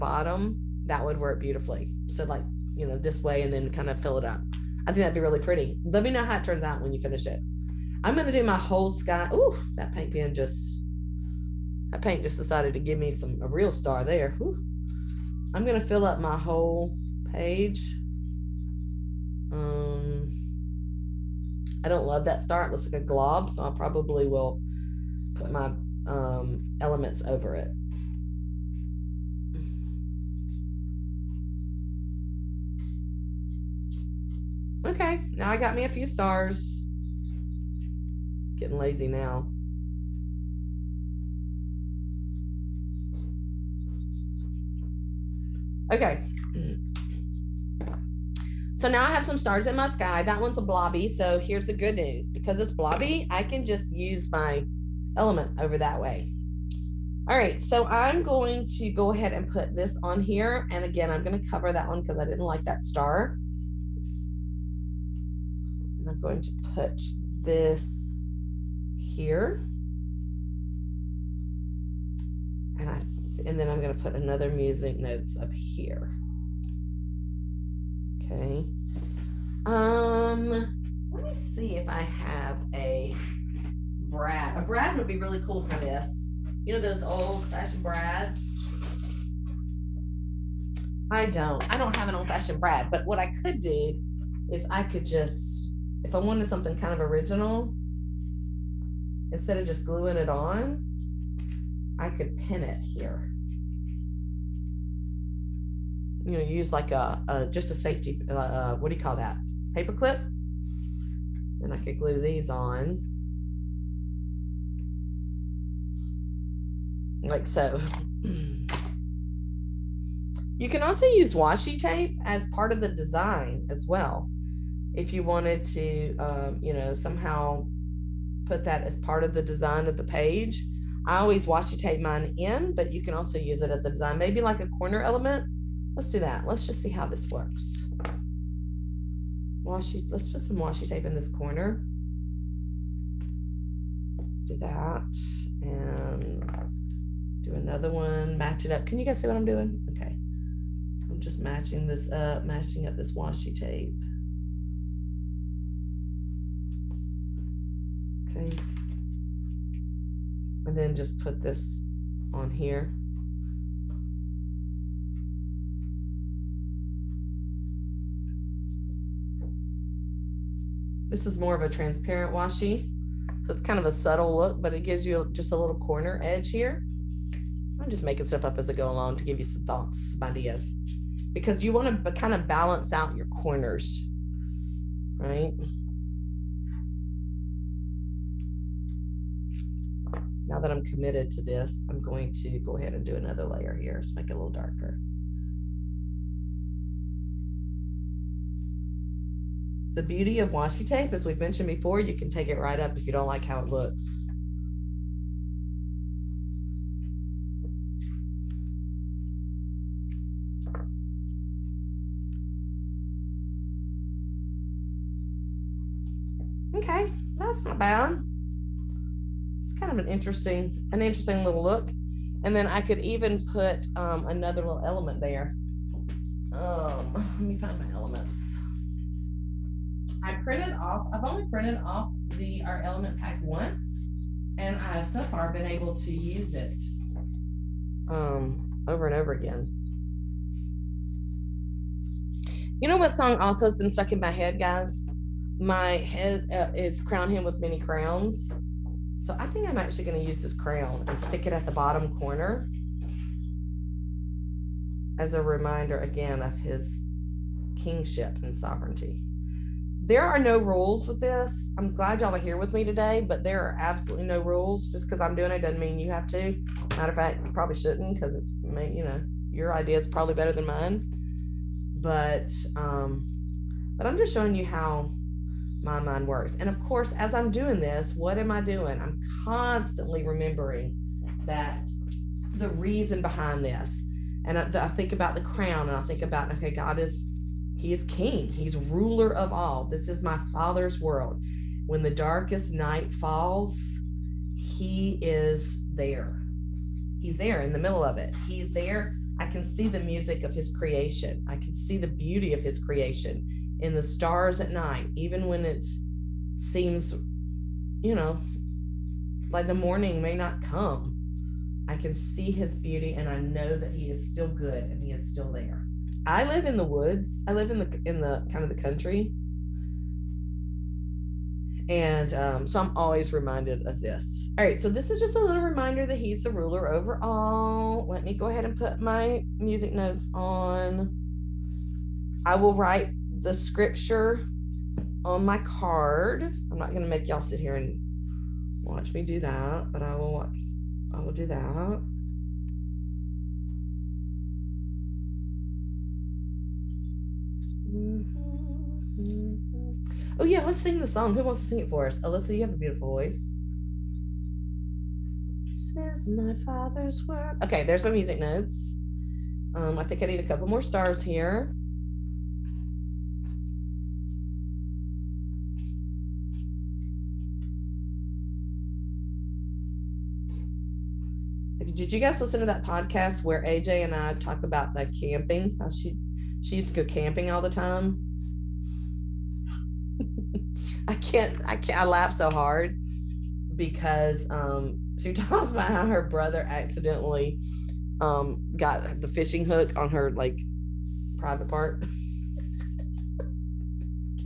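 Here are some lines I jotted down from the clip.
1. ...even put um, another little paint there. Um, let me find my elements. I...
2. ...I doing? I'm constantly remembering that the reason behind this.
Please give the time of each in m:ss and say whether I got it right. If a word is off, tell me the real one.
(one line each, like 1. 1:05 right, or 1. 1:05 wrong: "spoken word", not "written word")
1. 3:42 wrong: "element", not "paint"
2. 4:38 right.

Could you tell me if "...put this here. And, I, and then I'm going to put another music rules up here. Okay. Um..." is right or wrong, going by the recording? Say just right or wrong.
wrong.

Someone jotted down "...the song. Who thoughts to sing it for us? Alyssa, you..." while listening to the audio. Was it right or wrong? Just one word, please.
wrong.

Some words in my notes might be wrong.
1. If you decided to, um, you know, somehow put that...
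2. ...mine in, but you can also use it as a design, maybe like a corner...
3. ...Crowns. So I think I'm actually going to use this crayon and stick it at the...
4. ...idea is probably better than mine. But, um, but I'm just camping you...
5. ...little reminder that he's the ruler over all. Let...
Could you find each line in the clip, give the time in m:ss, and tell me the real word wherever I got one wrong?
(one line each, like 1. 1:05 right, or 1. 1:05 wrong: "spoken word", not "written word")
1. 2:04 wrong: "wanted", not "decided"
2. 2:12 right
3. 4:07 right
4. 4:29 wrong: "showing", not "camping"
5. 5:25 right.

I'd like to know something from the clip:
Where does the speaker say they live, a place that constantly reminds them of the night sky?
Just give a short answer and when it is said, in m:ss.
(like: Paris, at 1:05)
the woods, at 5:16.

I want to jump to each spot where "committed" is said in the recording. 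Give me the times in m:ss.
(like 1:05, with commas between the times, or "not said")
3:10.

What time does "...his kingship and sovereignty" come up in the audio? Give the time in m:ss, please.
4:16.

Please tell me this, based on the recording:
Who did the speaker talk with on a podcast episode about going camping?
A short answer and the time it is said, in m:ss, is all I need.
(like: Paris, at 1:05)
AJ, at 6:13.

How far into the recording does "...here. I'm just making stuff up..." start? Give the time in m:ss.
2:56.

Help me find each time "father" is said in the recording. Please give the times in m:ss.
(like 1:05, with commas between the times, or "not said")
4:50, 5:56.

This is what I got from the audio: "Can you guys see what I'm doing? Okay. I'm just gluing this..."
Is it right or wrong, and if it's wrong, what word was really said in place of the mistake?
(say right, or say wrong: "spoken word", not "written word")
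wrong: "matching", not "gluing".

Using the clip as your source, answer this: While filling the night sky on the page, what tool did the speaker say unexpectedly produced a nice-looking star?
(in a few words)
paint pen.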